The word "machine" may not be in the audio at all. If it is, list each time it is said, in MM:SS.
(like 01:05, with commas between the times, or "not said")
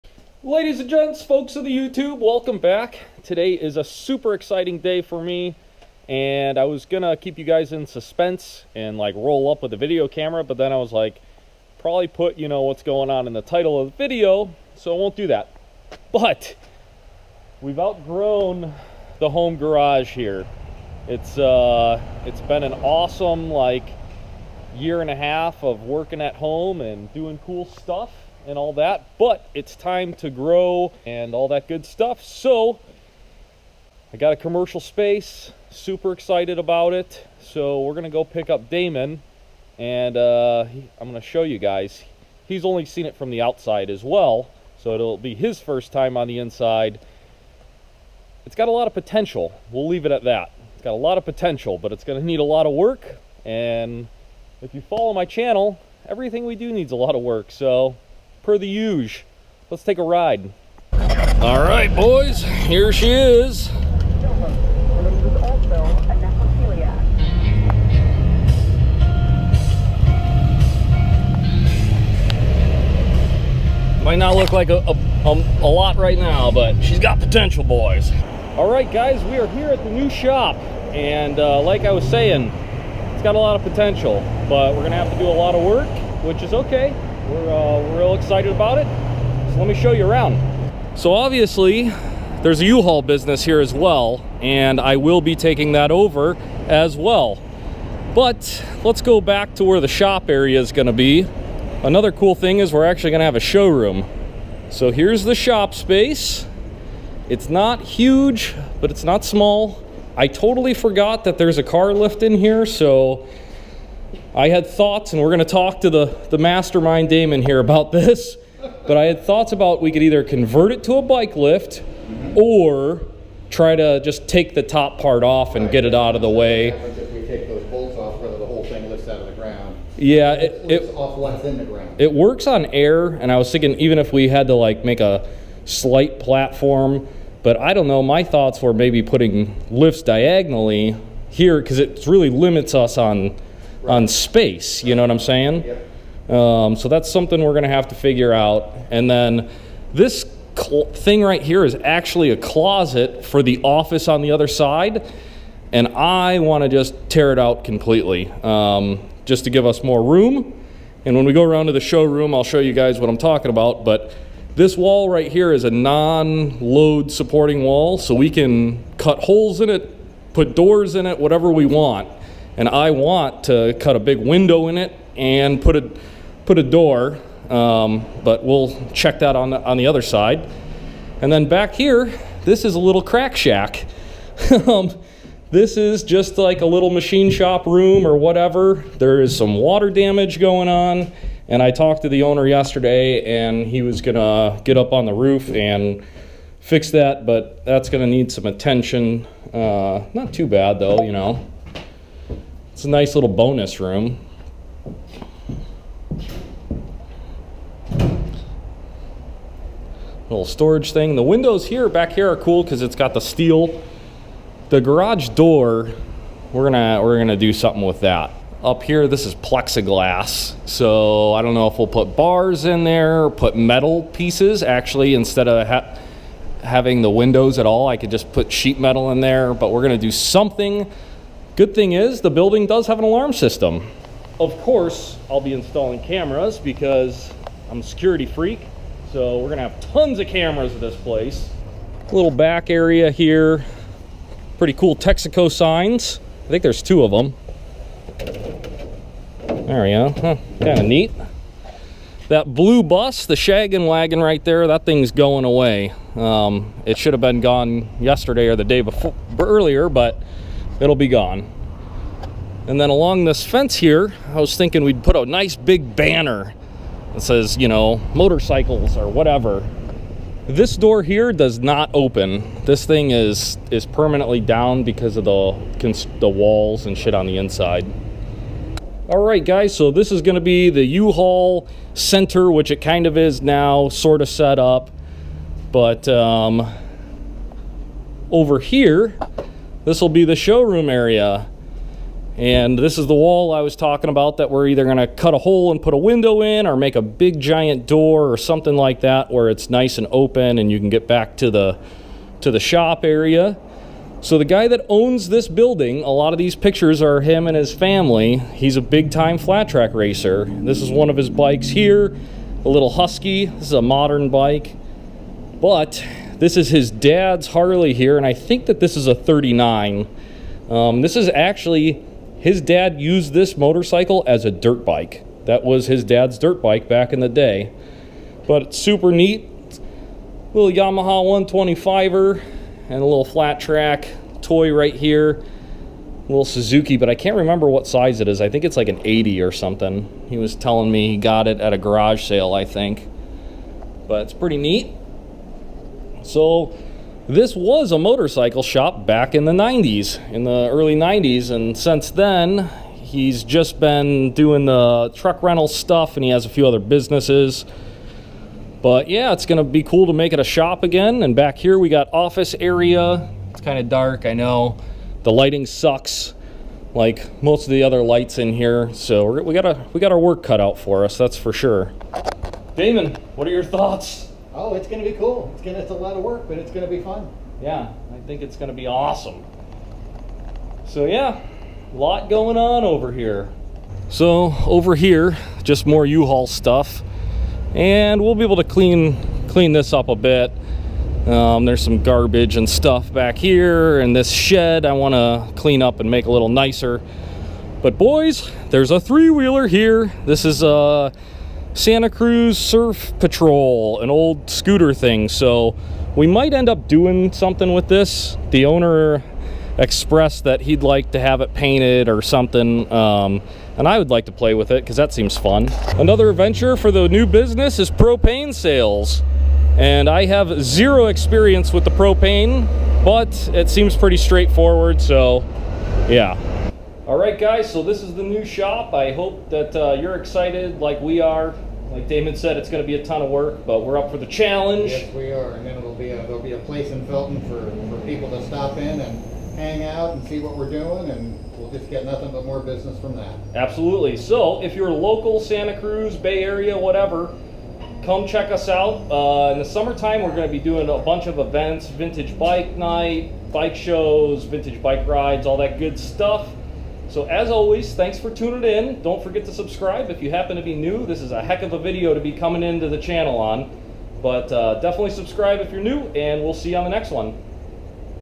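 03:06.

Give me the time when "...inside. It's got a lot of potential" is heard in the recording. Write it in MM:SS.
00:46.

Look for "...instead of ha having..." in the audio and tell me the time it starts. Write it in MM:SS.
03:45.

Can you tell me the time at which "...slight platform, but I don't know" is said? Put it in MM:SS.
02:15.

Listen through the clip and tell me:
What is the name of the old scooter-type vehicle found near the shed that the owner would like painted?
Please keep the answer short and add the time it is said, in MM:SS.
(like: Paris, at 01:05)
Santa Cruz Surf Patrol, at 06:41.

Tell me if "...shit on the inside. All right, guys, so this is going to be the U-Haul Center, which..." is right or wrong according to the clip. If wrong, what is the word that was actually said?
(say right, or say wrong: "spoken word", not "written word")
right.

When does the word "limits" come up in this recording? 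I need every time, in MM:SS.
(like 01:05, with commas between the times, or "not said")
02:22.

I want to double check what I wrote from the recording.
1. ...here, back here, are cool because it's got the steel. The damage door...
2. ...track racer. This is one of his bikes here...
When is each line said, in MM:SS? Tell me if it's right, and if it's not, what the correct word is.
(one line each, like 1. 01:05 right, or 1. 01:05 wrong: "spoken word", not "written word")
1. 03:31 wrong: "garage", not "damage"
2. 05:09 right.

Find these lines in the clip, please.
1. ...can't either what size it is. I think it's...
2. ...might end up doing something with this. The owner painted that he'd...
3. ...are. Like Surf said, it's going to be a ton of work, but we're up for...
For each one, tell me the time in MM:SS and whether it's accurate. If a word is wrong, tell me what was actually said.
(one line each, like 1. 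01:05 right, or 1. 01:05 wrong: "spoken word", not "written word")
1. 05:37 wrong: "remember", not "either"
2. 06:46 wrong: "expressed", not "painted"
3. 07:11 wrong: "Damon", not "Surf".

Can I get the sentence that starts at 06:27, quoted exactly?
And we'll be able to clean, clean this up a bit.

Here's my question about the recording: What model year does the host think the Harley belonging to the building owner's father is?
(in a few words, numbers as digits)
1939.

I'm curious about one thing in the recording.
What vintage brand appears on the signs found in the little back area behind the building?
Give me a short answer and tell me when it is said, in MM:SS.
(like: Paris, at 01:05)
Texaco, at 04:04.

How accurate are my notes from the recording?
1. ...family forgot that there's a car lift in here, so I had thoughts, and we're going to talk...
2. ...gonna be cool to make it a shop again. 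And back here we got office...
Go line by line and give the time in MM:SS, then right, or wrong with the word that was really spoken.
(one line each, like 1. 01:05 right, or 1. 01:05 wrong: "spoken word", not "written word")
1. 01:50 wrong: "totally", not "family"
2. 05:59 right.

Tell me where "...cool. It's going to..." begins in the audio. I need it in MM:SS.
06:15.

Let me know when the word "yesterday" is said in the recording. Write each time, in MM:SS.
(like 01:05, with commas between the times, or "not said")
03:12, 04:17.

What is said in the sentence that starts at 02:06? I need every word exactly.
If we take those bolts off, whether the whole thing lifts out of the ground.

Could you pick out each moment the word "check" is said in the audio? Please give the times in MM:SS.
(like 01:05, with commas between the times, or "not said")
02:58, 07:28.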